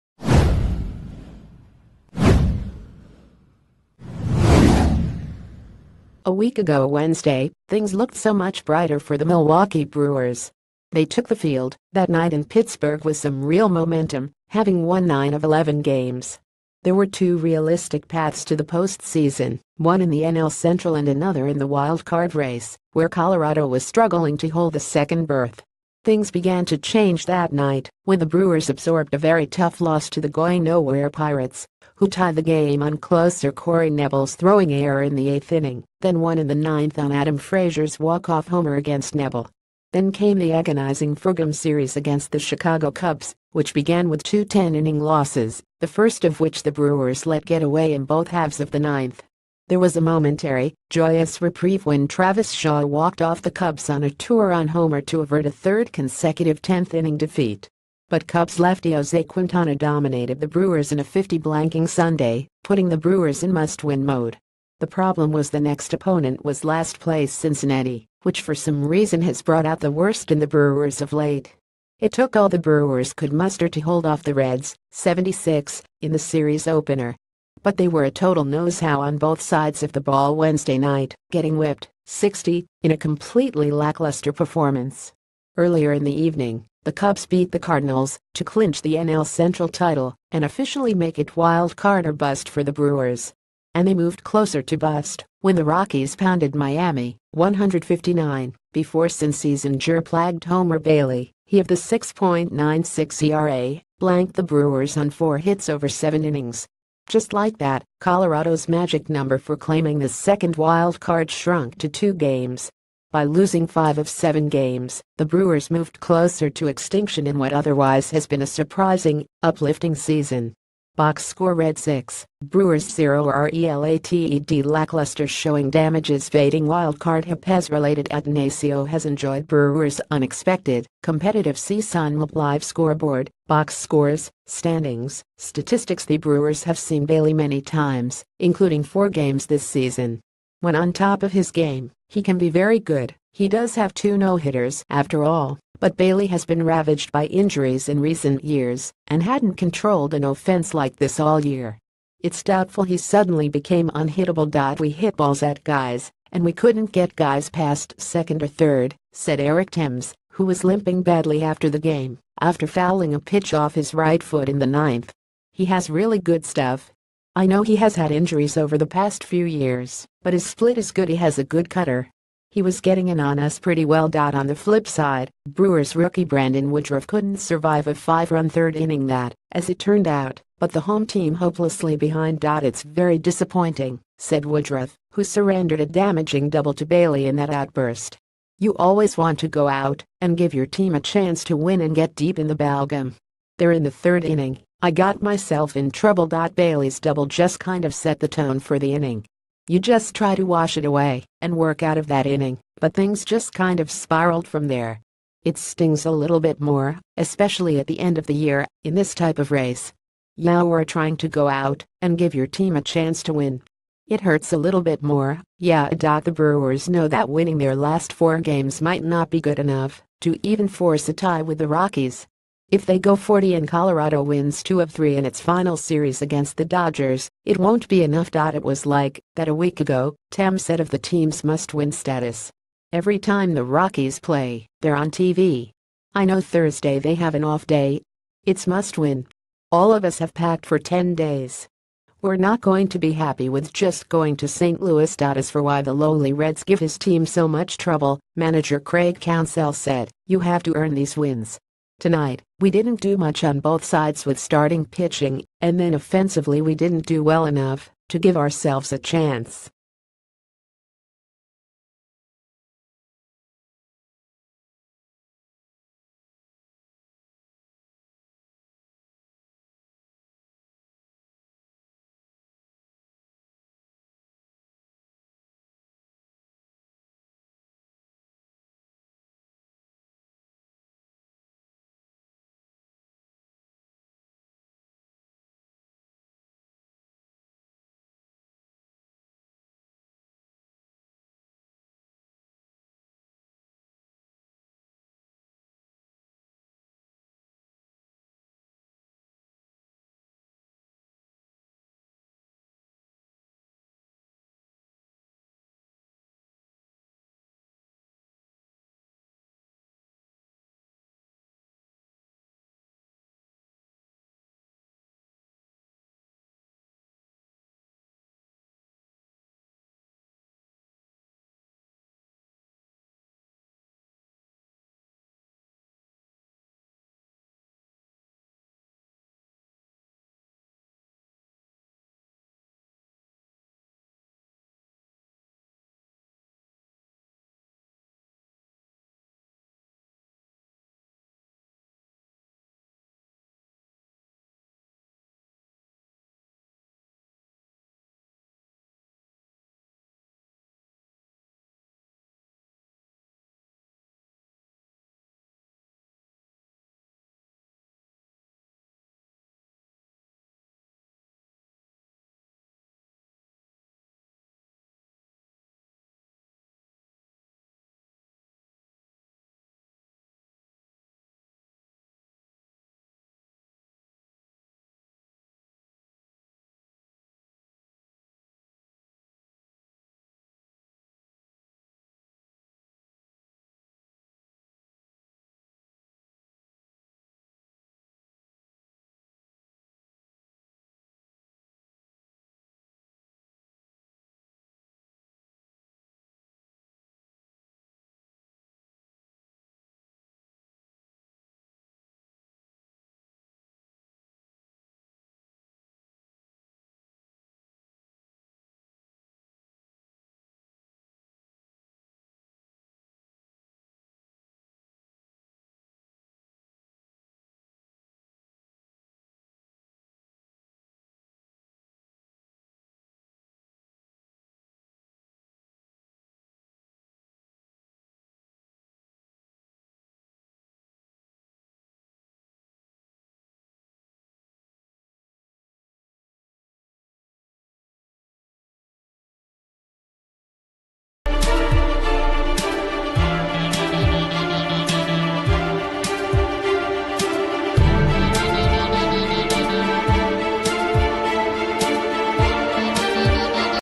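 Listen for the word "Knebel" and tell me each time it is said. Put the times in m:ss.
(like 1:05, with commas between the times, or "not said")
0:33, 0:39.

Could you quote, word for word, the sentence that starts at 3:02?
It's very disappointing, said Woodruff, who surrendered a damaging double to Bailey in that outburst.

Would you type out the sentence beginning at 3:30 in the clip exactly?
Now we are trying to go out and give your team a chance to win.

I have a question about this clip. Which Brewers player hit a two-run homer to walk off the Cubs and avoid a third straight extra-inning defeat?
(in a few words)
Travis Shaw.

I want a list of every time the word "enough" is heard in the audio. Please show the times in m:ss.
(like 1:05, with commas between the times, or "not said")
3:39, 3:48, 4:17.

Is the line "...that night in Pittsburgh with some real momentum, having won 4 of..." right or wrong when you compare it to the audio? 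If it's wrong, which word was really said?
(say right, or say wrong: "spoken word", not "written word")
wrong: "9", not "4".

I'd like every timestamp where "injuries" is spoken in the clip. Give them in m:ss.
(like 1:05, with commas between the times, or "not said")
2:27, 2:48.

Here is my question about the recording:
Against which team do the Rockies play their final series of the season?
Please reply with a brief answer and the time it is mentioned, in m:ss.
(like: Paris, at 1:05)
Dodgers, at 3:46.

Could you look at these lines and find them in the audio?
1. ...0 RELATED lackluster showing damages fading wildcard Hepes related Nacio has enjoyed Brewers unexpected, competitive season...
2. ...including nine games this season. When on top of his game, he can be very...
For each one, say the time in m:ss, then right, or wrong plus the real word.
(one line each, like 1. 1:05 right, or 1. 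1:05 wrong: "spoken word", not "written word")
1. 2:02 right
2. 2:18 wrong: "four", not "nine".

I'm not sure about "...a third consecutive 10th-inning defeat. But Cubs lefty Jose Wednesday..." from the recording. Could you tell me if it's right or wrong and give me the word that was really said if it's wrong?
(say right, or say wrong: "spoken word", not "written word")
wrong: "Quintana", not "Wednesday".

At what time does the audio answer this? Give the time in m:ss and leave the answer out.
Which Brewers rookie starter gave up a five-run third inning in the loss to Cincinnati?
2:56.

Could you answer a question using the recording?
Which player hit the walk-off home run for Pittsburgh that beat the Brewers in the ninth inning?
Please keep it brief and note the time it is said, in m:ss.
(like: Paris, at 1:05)
Adam Frazier, at 0:37.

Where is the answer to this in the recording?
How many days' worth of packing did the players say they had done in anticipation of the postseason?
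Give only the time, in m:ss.
4:00.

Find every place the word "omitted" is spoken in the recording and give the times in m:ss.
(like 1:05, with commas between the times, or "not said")
not said.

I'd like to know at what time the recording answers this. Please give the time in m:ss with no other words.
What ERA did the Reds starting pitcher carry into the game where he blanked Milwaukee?
1:41.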